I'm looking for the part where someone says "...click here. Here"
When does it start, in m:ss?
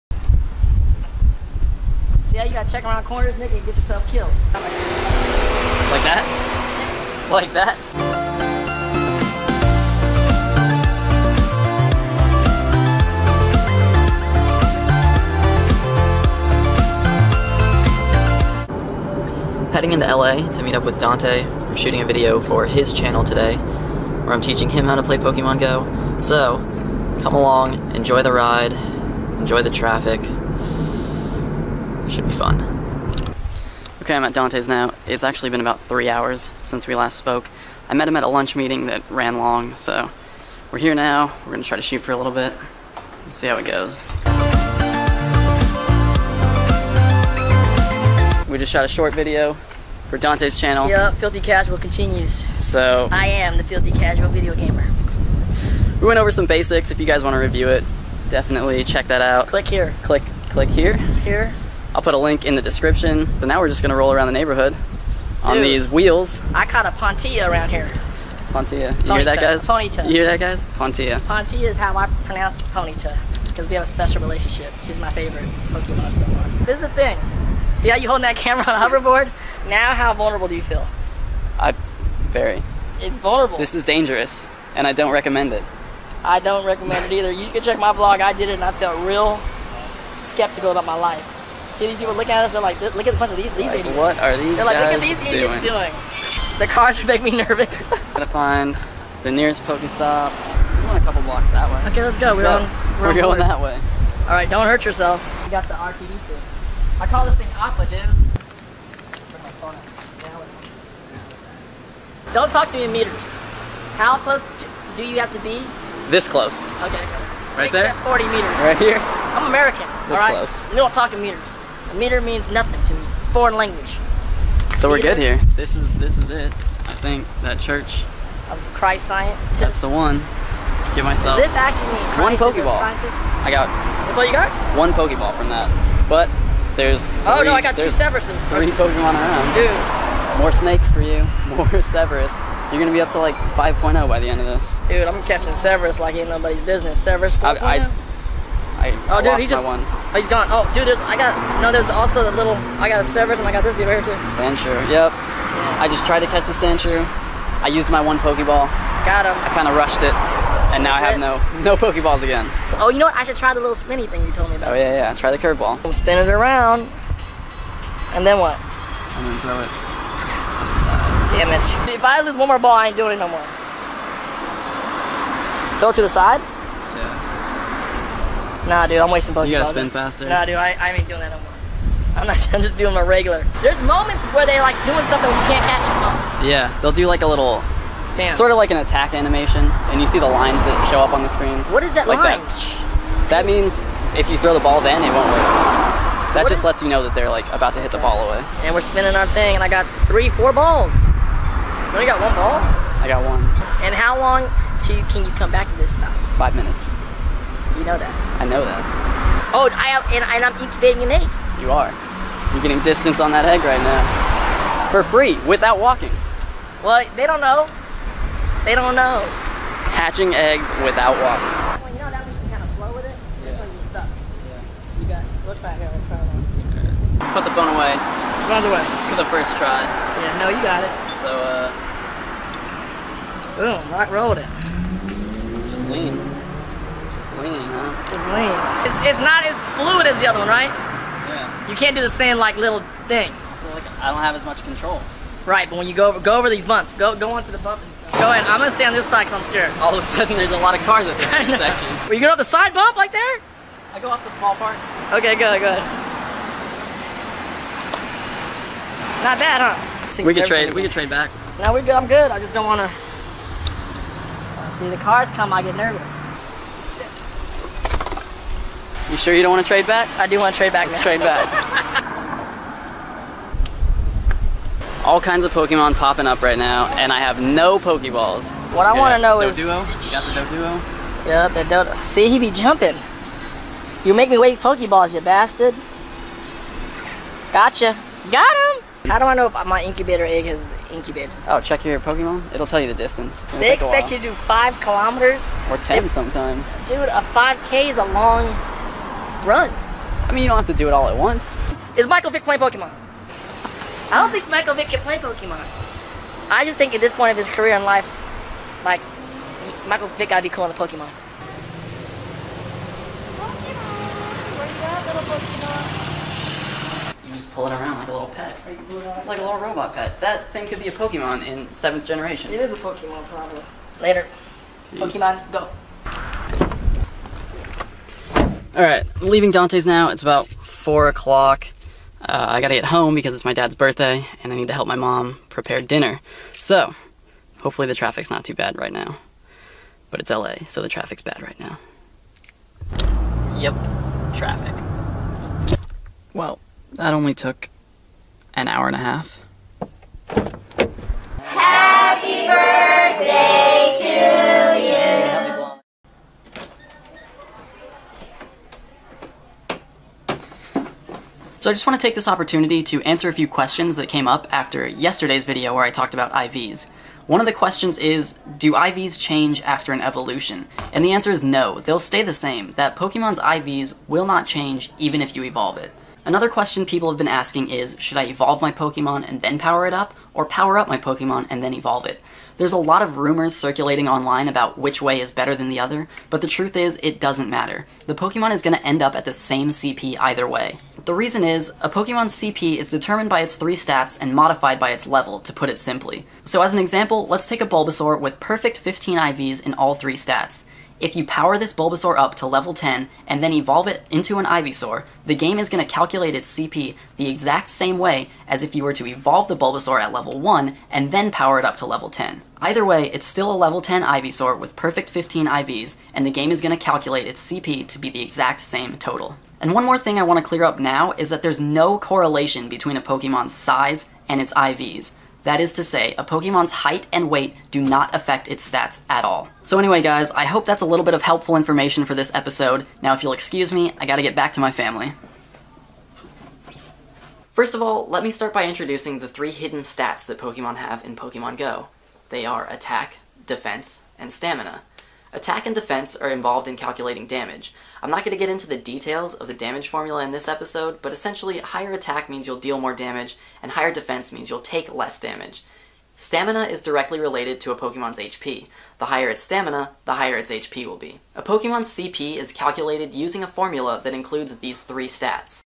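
1:00.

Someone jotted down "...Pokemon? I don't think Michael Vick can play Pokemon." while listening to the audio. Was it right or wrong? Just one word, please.
right.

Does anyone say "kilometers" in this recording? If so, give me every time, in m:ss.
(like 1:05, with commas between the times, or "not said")
4:54.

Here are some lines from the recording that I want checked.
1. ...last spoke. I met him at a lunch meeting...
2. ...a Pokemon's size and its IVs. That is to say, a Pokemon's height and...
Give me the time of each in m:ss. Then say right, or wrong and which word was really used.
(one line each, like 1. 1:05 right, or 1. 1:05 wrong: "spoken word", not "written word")
1. 0:36 right
2. 7:02 right.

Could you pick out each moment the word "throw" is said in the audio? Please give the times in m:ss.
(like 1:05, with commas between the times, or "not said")
2:49, 2:55, 3:14.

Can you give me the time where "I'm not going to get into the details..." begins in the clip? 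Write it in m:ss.
7:28.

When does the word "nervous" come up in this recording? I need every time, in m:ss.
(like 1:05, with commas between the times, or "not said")
1:37, 4:25.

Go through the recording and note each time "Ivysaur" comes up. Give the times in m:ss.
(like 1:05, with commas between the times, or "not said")
6:44, 6:54.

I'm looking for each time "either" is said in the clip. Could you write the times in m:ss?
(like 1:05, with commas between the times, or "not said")
1:27, 6:30, 6:52.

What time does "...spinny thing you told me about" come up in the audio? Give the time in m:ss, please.
2:43.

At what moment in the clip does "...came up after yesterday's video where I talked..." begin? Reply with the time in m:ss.
6:04.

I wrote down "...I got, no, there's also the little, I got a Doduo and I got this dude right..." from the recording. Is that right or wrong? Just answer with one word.
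wrong.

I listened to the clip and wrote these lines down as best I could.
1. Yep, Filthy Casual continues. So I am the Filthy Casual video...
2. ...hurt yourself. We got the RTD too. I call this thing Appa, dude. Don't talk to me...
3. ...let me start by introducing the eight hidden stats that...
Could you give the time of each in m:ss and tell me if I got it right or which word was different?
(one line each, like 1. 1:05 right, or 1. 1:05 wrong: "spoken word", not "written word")
1. 0:50 right
2. 1:44 right
3. 7:18 wrong: "three", not "eight".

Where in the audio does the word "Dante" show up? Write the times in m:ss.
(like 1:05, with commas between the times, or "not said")
0:20, 0:34, 0:50, 5:29.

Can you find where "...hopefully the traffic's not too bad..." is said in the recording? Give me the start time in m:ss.
5:37.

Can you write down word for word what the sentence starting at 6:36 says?
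So as an example, let's take a Bulbasaur with perfect 15 IVs in all three stats.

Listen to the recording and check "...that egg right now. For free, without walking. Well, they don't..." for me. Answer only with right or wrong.
right.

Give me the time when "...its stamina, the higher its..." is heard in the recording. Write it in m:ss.
7:39.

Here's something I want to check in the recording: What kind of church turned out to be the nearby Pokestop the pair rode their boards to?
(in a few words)
Christ Scientist.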